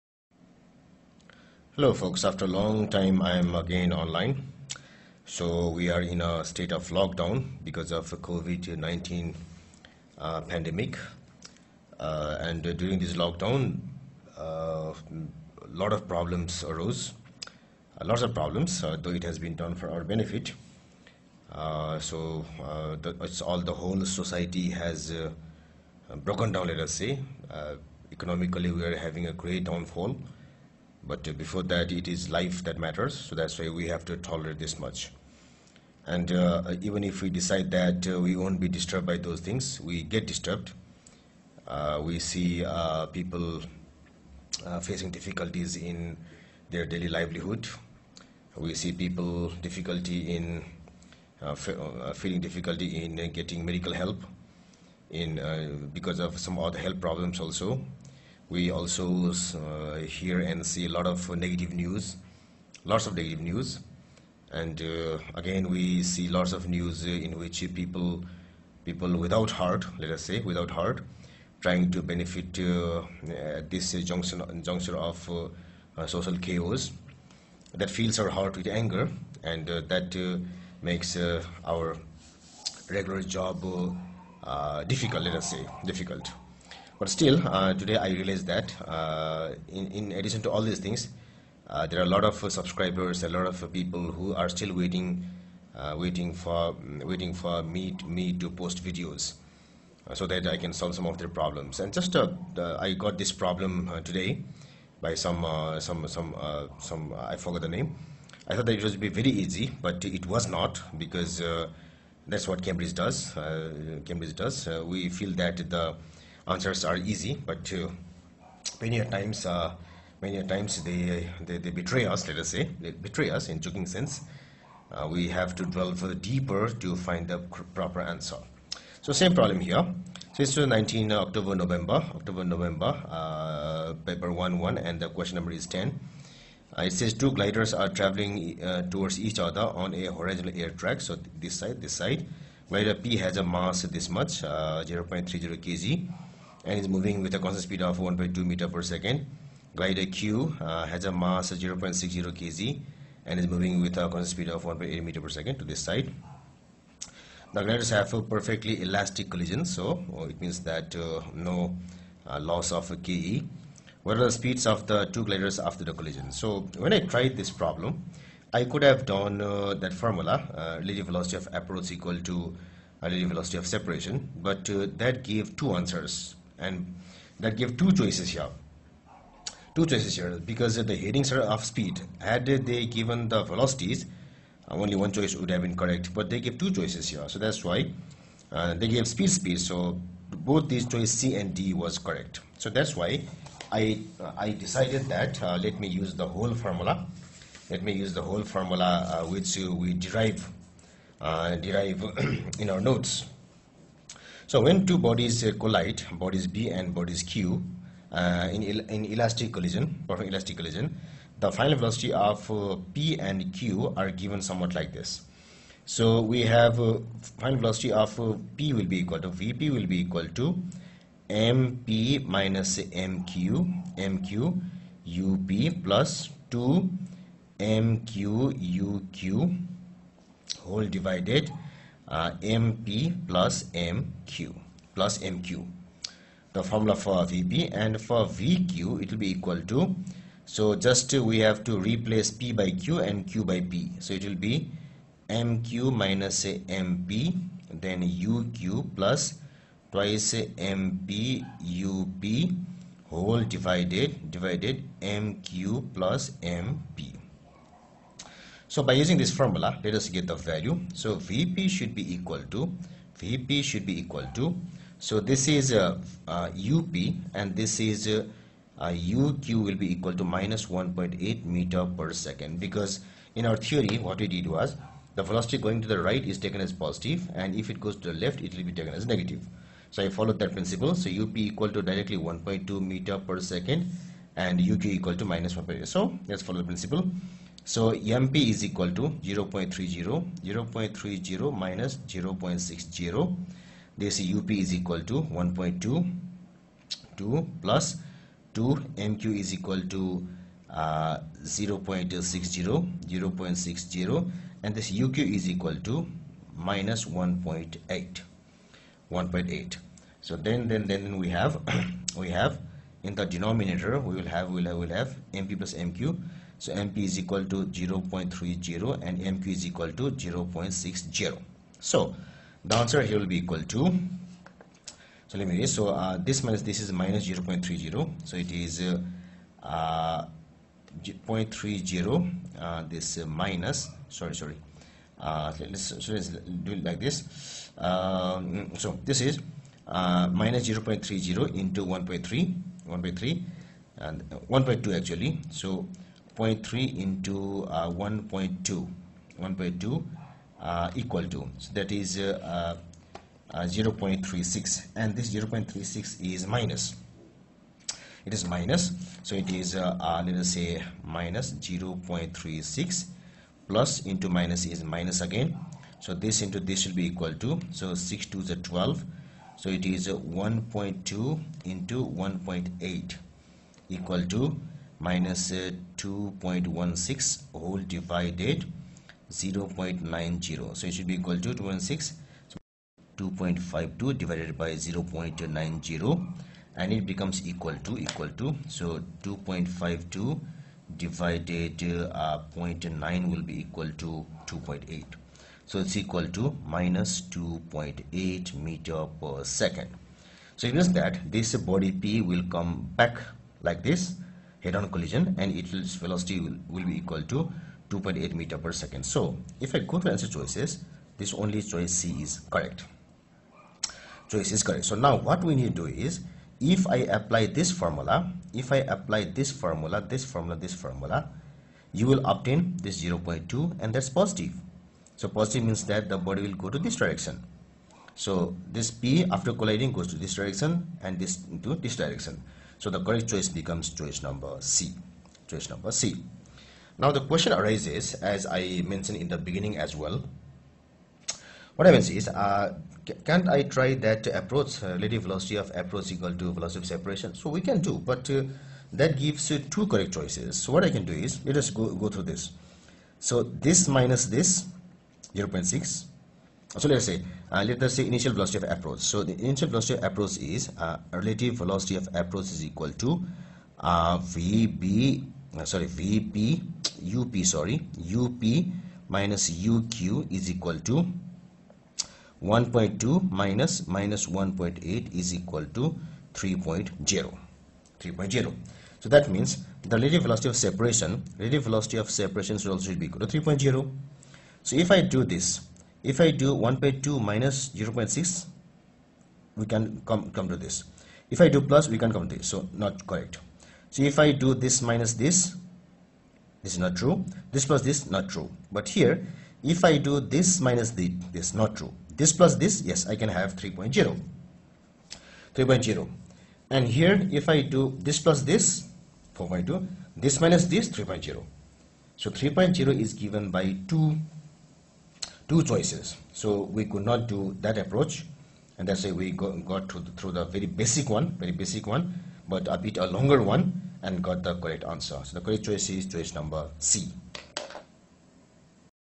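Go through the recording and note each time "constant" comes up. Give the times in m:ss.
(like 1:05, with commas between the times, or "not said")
2:27, 2:34.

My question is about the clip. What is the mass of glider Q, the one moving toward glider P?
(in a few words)
0.60 kg.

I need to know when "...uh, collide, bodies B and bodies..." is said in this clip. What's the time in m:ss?
3:25.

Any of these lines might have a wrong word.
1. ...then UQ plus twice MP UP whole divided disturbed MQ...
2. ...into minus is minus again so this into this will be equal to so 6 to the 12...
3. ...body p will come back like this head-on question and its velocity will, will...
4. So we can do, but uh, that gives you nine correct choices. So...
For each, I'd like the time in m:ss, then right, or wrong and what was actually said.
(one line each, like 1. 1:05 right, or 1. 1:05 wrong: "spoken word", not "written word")
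1. 4:07 wrong: "divided", not "disturbed"
2. 6:04 right
3. 6:41 wrong: "collision", not "question"
4. 7:27 wrong: "two", not "nine".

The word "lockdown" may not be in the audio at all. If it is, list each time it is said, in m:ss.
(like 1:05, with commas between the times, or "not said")
0:06, 0:13.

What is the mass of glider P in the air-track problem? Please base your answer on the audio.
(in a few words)
0.30 kg.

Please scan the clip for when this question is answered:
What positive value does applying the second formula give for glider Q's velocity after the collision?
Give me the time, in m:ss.
7:03.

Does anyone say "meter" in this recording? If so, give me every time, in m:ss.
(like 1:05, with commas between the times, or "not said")
2:28, 2:35, 4:31, 4:42, 6:38, 6:48.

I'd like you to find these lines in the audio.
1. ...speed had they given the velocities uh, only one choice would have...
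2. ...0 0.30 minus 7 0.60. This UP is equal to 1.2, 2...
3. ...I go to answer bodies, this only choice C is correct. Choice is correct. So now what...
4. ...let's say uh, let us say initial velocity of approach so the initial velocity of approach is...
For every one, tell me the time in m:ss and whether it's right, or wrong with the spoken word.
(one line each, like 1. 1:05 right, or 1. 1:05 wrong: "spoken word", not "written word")
1. 3:01 right
2. 4:49 wrong: "0", not "7"
3. 6:49 wrong: "choices", not "bodies"
4. 7:36 right.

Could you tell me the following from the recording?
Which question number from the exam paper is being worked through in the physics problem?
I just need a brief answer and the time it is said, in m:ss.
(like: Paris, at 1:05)
10, at 2:15.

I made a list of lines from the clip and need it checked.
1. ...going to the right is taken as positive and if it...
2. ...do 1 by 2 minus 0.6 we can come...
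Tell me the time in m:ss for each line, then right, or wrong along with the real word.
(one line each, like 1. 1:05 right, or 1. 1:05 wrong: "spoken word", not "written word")
1. 4:35 right
2. 8:06 right.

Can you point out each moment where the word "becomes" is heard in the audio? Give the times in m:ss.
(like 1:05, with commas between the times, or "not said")
6:27, 7:13.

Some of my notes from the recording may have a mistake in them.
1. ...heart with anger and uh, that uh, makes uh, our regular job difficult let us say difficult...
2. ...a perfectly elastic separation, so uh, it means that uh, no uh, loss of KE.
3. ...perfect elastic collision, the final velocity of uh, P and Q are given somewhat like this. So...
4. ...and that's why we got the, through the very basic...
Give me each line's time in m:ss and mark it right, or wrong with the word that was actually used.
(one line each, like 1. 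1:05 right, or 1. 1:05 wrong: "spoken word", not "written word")
1. 1:18 right
2. 2:38 wrong: "collision", not "separation"
3. 3:30 right
4. 8:38 right.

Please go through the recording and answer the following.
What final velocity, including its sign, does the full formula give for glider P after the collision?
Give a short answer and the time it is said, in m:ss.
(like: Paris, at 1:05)
-2.8 m/s, at 6:36.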